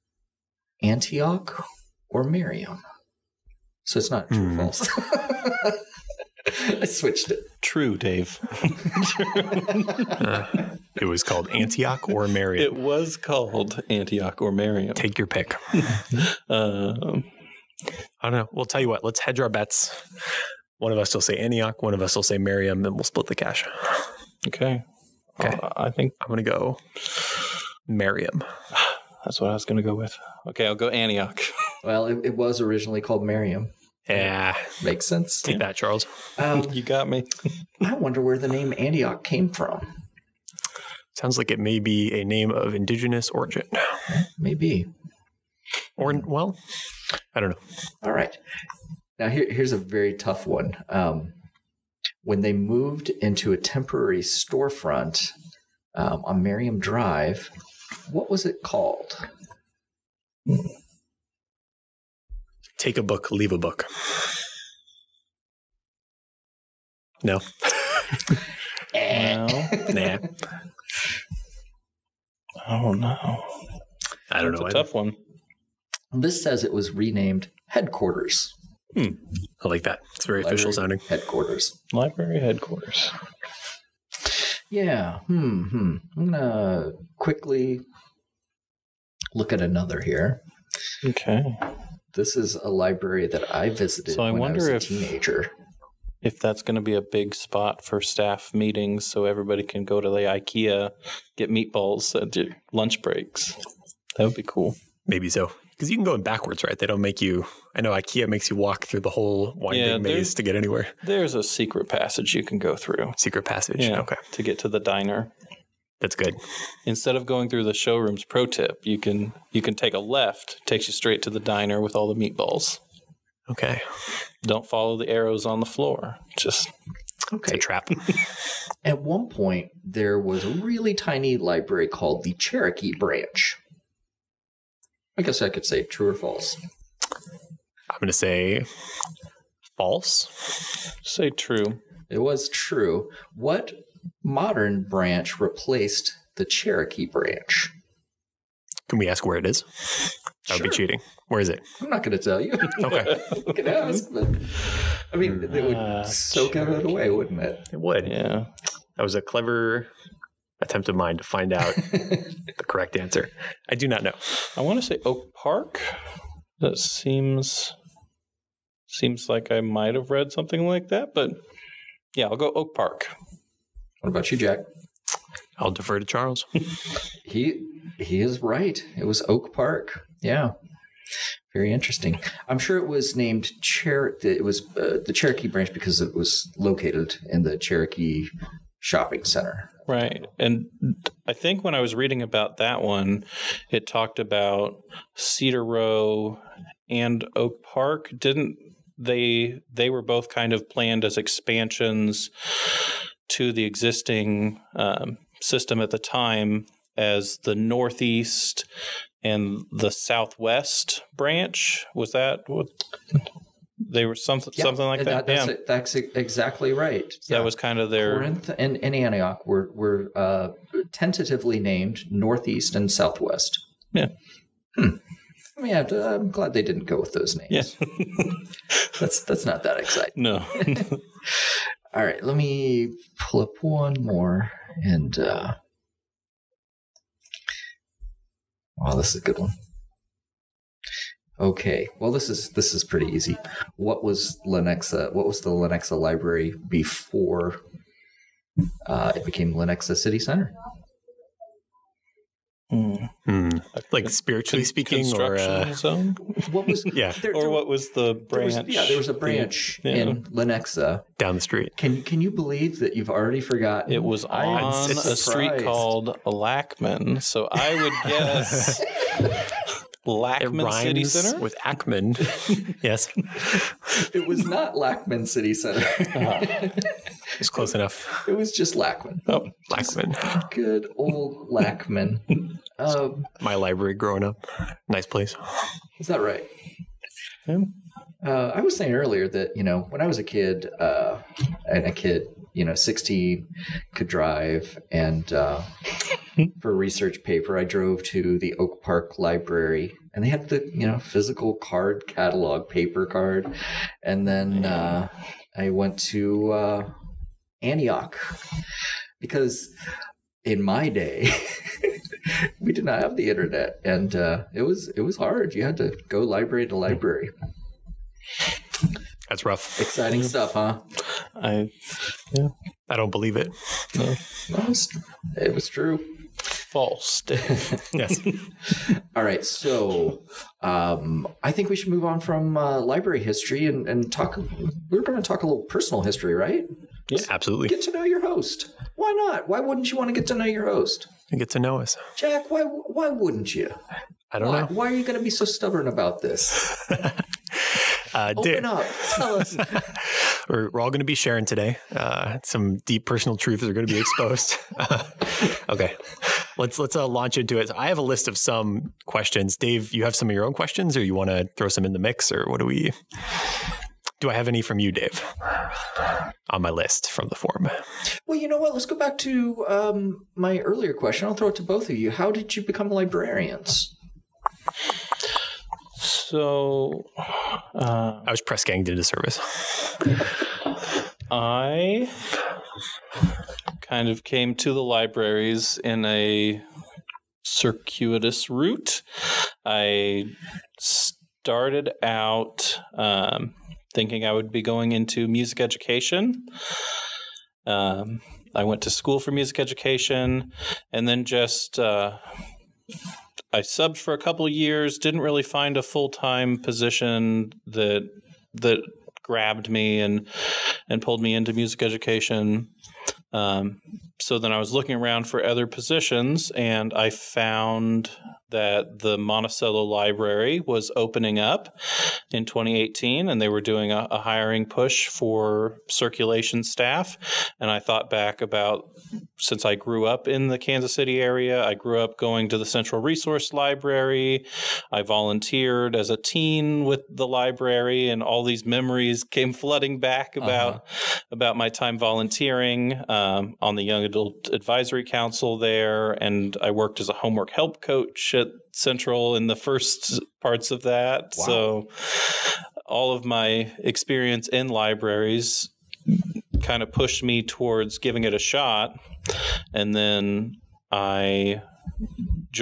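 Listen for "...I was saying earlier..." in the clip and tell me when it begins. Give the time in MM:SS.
04:48.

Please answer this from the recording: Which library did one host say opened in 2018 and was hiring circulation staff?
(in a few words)
Monticello Library.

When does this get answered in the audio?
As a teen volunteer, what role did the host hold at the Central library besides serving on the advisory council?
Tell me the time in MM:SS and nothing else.
07:27.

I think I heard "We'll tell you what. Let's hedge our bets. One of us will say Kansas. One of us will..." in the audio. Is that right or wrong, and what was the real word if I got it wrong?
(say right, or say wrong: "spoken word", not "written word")
wrong: "Antioch", not "Kansas".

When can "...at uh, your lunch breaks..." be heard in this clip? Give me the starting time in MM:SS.
01:42.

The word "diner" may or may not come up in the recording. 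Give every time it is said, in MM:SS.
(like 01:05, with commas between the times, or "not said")
01:54, 02:01.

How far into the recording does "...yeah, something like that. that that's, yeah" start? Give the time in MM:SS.
03:34.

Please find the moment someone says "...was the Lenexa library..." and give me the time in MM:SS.
04:05.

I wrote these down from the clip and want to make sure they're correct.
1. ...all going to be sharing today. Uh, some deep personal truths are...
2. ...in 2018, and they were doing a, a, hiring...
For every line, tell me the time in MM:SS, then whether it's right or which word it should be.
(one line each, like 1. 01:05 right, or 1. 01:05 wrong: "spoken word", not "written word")
1. 05:50 right
2. 07:02 right.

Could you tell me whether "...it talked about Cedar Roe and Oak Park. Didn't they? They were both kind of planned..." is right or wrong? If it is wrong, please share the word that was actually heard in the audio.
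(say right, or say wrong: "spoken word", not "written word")
right.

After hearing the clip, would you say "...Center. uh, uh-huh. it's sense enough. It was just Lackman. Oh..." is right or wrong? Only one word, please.
wrong.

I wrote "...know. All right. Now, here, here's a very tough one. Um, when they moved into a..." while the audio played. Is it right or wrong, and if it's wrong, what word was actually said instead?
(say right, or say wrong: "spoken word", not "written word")
right.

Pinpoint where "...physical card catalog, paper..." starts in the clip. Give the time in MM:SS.
05:00.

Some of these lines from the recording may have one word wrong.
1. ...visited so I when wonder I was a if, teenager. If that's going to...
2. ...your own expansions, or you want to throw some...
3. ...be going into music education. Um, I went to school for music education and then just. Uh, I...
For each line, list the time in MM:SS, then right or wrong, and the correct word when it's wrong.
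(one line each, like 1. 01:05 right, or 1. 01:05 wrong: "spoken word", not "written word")
1. 01:33 right
2. 06:00 wrong: "questions", not "expansions"
3. 06:34 right.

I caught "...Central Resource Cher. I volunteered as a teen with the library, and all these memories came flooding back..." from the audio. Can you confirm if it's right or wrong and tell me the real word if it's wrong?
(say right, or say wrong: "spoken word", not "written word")
wrong: "Library", not "Cher".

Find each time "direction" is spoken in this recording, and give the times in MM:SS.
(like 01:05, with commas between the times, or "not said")
not said.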